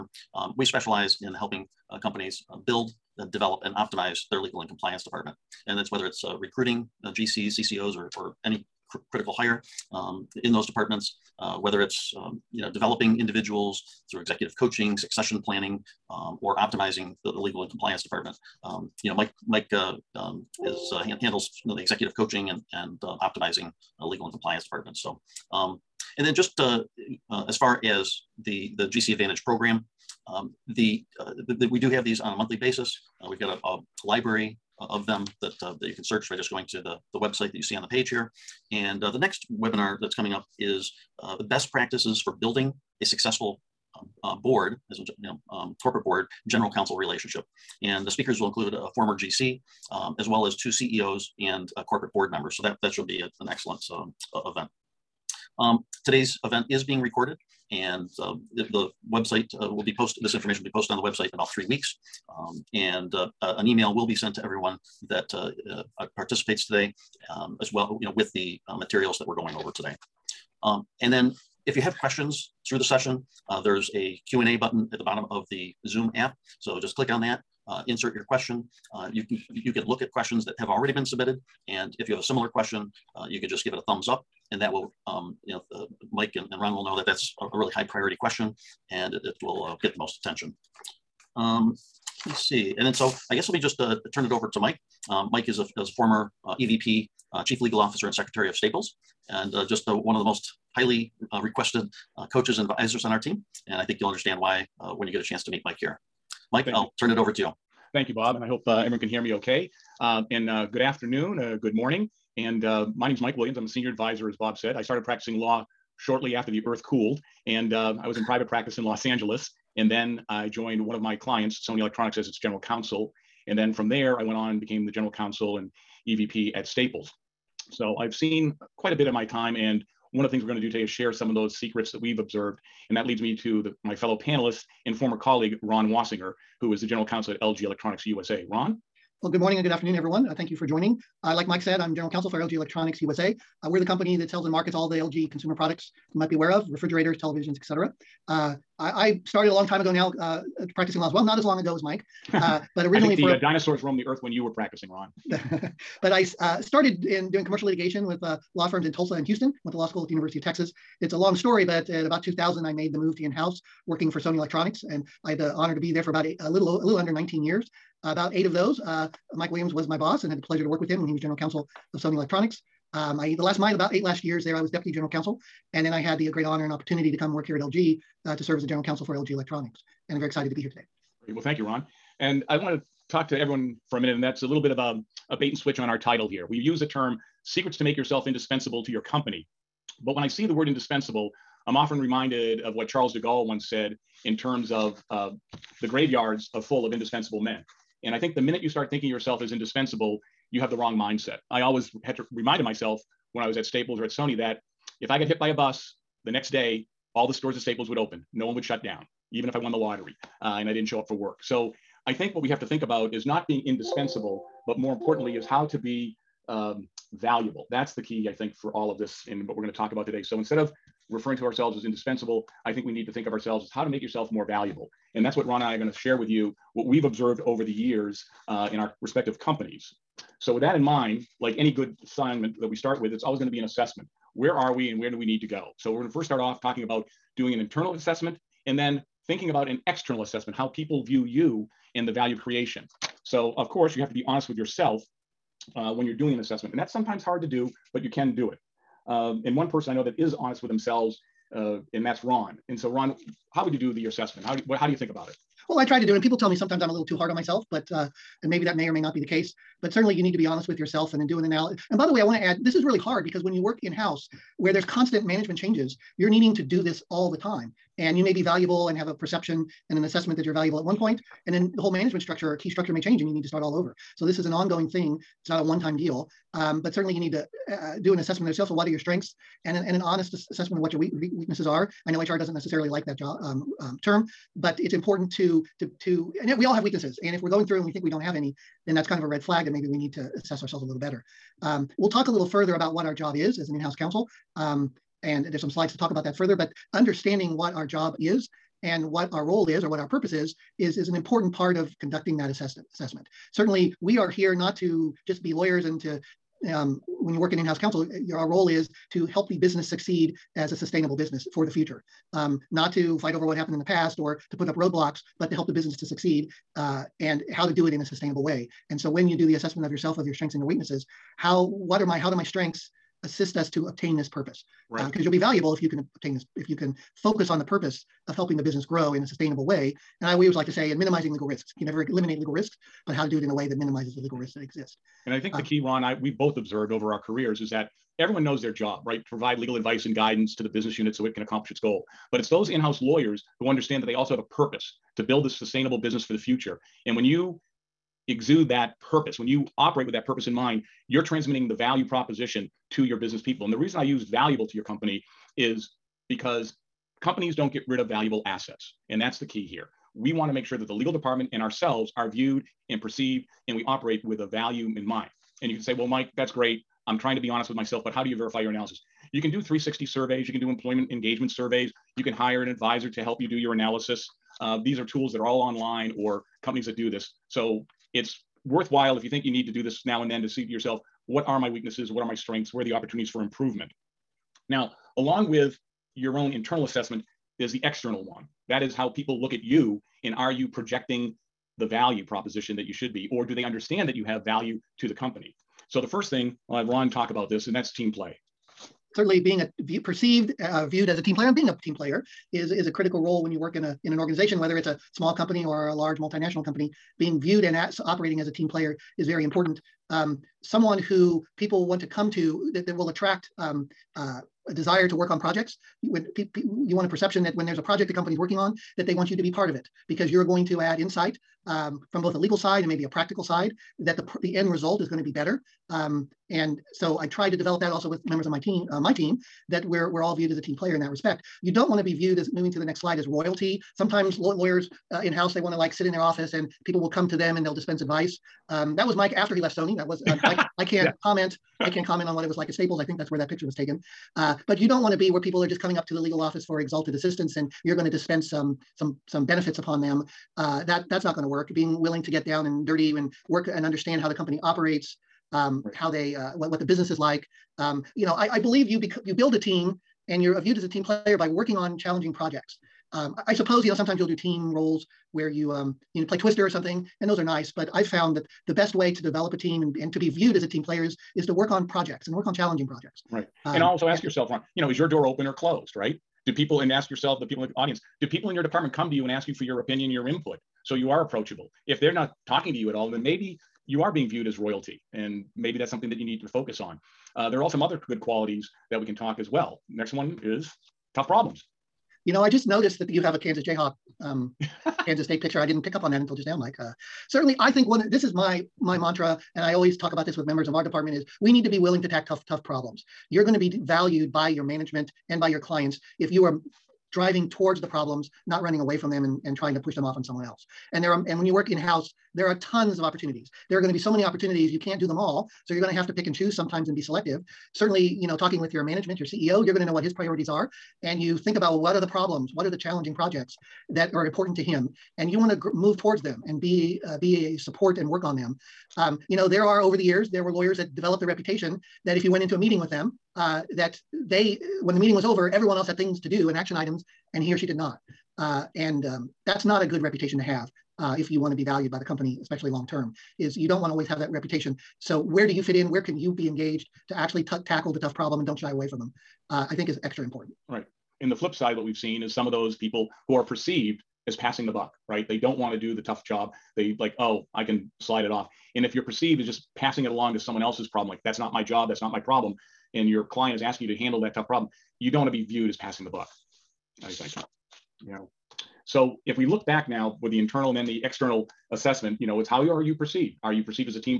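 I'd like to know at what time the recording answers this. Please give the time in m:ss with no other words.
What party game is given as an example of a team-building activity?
7:46.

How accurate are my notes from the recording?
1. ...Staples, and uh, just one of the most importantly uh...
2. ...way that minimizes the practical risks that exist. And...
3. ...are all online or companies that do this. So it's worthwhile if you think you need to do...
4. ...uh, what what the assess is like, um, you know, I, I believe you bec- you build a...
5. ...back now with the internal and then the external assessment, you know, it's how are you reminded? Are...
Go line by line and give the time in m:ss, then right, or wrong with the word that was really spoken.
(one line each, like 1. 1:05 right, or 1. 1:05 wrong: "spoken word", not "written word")
1. 1:38 wrong: "highly", not "importantly"
2. 5:33 wrong: "legal", not "practical"
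3. 6:15 right
4. 7:36 wrong: "business", not "assess"
5. 9:29 wrong: "perceived", not "reminded".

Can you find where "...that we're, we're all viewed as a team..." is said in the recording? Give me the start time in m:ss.
7:09.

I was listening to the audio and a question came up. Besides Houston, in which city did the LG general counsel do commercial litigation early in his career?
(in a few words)
Tulsa.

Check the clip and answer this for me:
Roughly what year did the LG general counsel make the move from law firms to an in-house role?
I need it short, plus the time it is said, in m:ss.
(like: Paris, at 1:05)
2000, at 2:42.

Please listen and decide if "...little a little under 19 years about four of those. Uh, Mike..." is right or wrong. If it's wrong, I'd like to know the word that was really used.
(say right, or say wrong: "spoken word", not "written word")
wrong: "eight", not "four".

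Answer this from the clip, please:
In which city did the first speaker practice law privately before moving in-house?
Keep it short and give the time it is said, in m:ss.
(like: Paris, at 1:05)
Los Angeles, at 1:58.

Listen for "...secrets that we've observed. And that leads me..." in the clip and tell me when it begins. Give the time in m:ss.
2:11.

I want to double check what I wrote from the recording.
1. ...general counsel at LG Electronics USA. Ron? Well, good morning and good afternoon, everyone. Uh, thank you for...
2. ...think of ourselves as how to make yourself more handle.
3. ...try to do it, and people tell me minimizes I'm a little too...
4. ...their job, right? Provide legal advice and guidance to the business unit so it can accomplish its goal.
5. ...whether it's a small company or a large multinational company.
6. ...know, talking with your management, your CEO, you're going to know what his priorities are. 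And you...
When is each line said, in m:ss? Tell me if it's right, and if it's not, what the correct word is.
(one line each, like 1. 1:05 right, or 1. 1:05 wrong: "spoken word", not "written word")
1. 2:16 right
2. 3:43 wrong: "valuable", not "handle"
3. 4:15 wrong: "sometimes", not "minimizes"
4. 5:38 right
5. 6:44 right
6. 8:38 right.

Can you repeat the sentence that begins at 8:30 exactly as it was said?
And there are, and when you work in-house, there are tons of opportunities.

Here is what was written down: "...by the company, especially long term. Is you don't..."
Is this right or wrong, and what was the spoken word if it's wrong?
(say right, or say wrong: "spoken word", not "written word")
right.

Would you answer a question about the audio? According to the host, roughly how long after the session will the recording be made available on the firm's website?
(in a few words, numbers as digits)
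3 weeks.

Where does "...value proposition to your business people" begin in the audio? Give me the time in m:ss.
5:51.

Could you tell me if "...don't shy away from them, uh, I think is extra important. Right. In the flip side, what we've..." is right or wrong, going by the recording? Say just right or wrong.
right.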